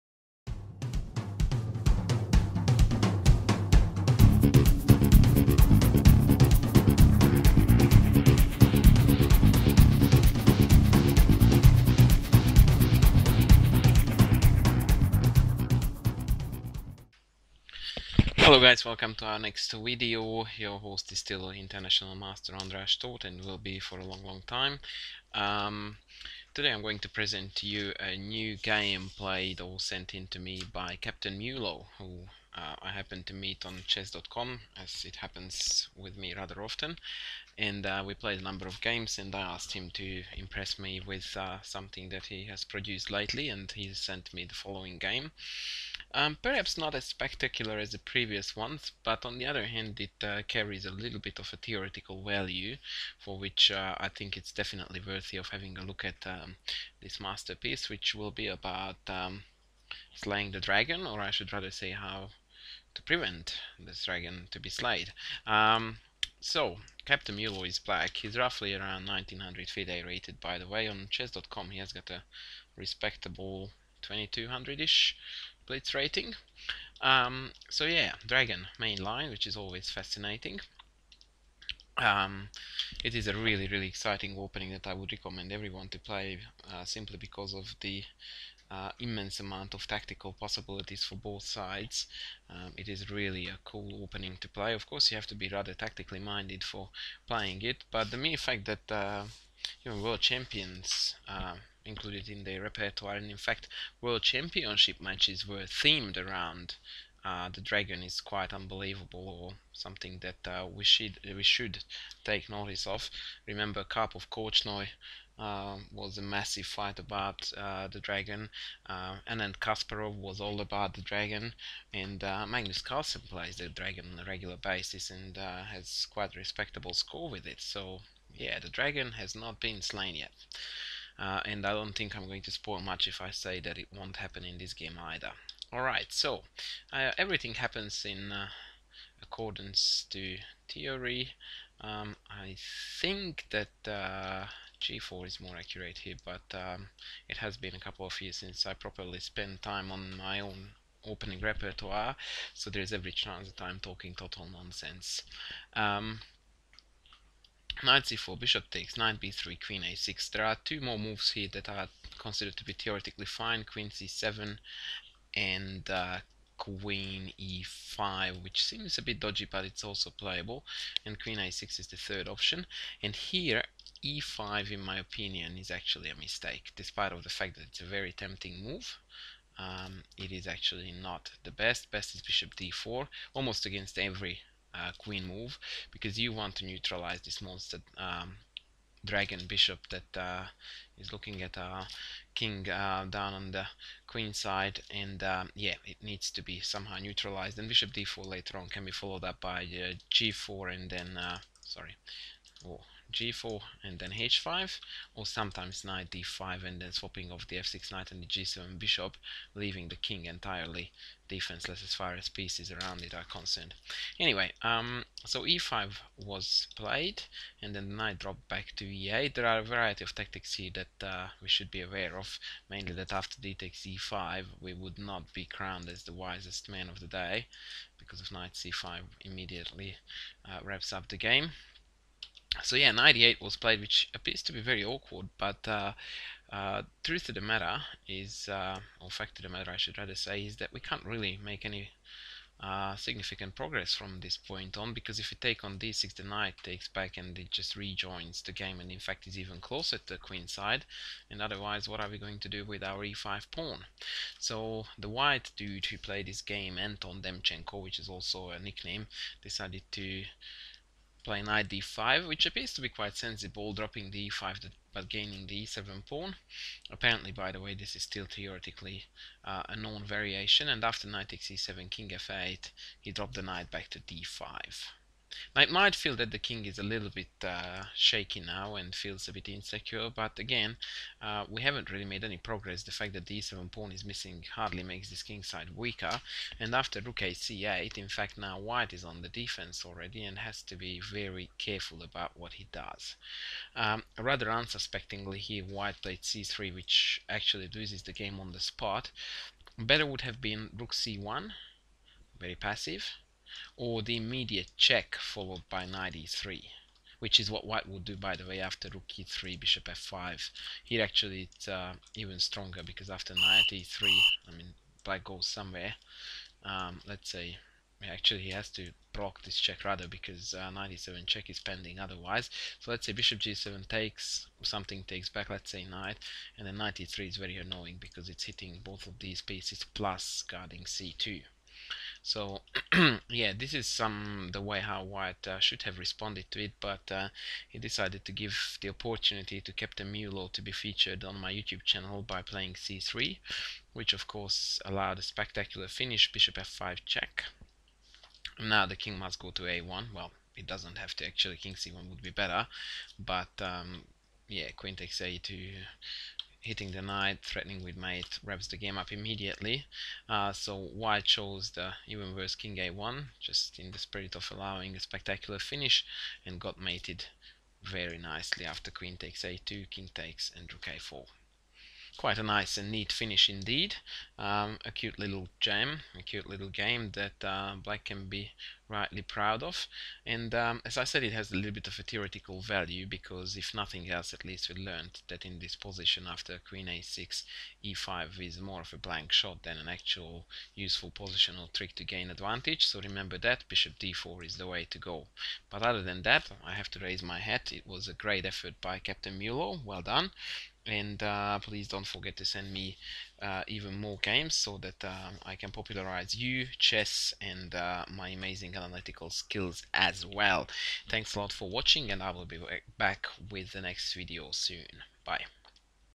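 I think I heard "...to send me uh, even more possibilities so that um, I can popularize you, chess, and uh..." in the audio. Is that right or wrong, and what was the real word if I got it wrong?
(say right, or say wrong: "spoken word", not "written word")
wrong: "games", not "possibilities".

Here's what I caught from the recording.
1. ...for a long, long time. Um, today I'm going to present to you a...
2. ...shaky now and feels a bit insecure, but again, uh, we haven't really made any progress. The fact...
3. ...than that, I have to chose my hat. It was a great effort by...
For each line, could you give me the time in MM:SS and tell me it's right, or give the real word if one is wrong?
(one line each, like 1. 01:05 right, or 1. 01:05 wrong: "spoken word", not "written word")
1. 00:23 right
2. 04:37 right
3. 06:36 wrong: "raise", not "chose".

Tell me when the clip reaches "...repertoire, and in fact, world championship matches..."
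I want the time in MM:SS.
01:42.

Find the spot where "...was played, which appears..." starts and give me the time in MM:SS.
03:53.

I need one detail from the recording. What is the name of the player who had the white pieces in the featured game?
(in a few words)
Anton Demchenko.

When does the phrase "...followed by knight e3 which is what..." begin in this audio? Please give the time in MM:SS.
05:05.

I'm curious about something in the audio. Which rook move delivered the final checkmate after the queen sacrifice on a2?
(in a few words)
Rook a4.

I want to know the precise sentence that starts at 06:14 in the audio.
Um, a cute little gem, a cute little game that uh, Black can be rightly proud of.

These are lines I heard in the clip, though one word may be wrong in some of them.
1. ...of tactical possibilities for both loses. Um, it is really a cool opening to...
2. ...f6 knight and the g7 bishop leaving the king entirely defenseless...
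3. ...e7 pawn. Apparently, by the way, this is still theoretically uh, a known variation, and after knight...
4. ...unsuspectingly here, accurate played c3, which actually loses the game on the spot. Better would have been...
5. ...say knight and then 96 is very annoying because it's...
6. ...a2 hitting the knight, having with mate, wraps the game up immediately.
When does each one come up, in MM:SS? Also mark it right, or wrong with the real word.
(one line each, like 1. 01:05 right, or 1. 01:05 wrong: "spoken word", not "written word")
1. 01:29 wrong: "sides", not "loses"
2. 03:27 right
3. 04:25 right
4. 04:54 wrong: "white", not "accurate"
5. 05:25 wrong: "93", not "96"
6. 05:55 wrong: "threatening", not "having".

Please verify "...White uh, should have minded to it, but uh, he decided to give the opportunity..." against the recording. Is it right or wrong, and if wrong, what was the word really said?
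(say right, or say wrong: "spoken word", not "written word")
wrong: "responded", not "minded".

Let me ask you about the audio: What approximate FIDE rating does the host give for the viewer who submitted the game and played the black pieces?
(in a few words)
1900.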